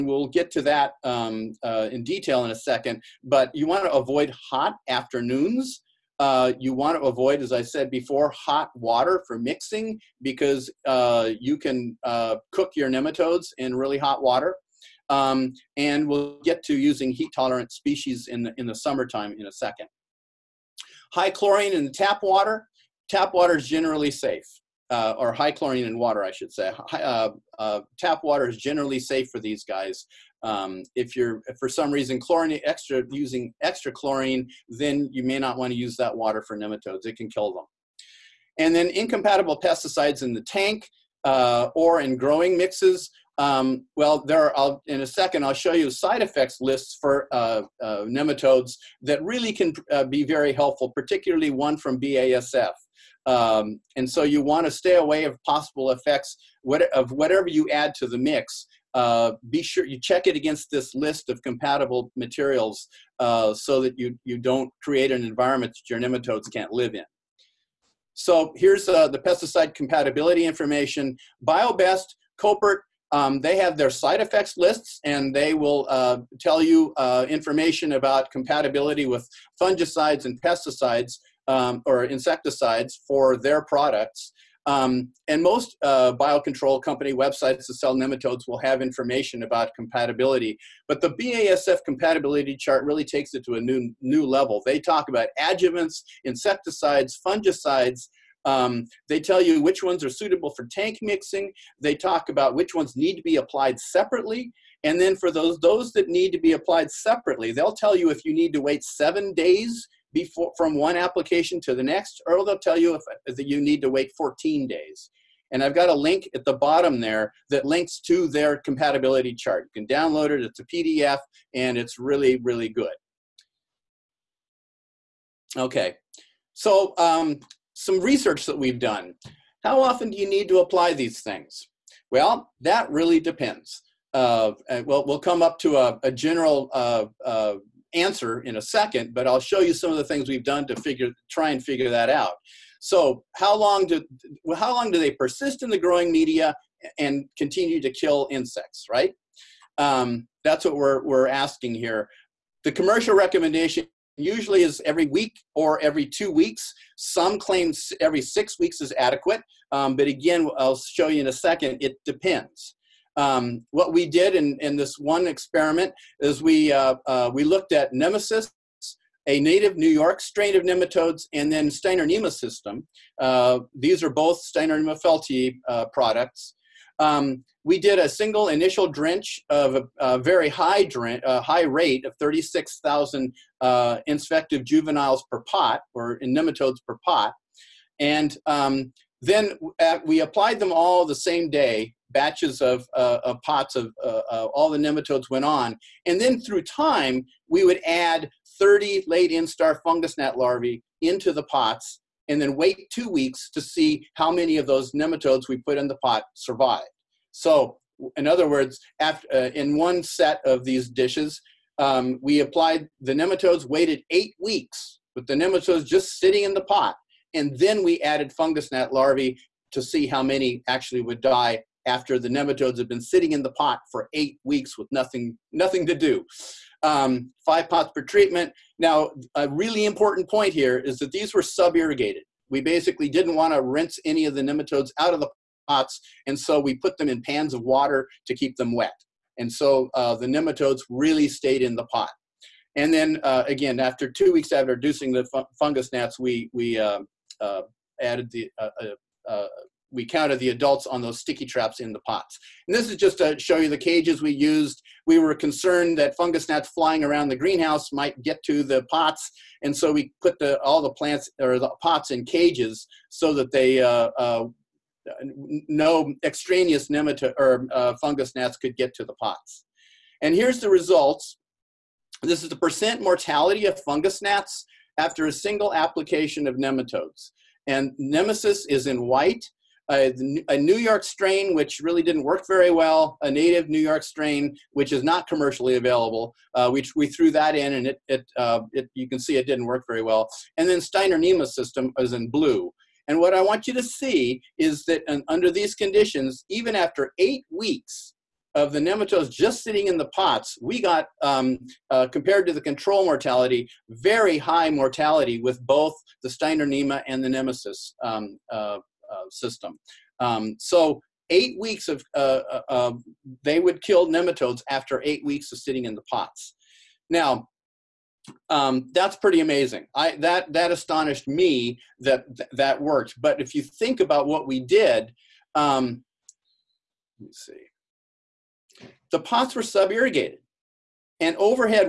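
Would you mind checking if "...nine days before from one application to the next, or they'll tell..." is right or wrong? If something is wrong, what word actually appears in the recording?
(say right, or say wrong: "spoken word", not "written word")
wrong: "seven", not "nine".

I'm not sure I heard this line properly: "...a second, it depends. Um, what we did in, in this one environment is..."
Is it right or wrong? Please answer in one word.
wrong.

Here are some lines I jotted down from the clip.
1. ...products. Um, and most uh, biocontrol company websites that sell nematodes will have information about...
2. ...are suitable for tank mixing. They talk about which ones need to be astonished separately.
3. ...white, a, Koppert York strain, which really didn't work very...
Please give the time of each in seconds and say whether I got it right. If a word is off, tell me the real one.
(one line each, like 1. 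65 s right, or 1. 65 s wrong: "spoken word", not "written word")
1. 83 s right
2. 100 s wrong: "applied", not "astonished"
3. 279 s wrong: "New", not "Koppert".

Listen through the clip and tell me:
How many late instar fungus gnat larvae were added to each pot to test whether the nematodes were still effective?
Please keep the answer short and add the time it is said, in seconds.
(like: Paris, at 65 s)
30, at 198 s.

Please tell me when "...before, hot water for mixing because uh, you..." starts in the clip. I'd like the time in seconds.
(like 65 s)
7 s.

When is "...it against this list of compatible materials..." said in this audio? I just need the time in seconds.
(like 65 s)
60 s.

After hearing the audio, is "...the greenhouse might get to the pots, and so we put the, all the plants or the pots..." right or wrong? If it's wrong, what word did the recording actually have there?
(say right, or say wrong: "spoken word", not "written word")
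right.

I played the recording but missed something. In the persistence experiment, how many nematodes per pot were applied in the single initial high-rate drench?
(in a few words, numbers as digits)
36,000.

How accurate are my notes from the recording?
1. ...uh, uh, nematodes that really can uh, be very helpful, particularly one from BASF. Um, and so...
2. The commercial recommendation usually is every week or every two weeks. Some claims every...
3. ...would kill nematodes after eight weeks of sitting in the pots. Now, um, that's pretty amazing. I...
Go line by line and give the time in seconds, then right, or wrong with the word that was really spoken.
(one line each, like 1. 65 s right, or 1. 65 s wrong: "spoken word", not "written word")
1. 47 s right
2. 152 s right
3. 313 s right.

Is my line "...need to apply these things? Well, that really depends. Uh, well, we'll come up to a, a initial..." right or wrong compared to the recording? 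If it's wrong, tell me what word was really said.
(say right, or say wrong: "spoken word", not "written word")
wrong: "general", not "initial".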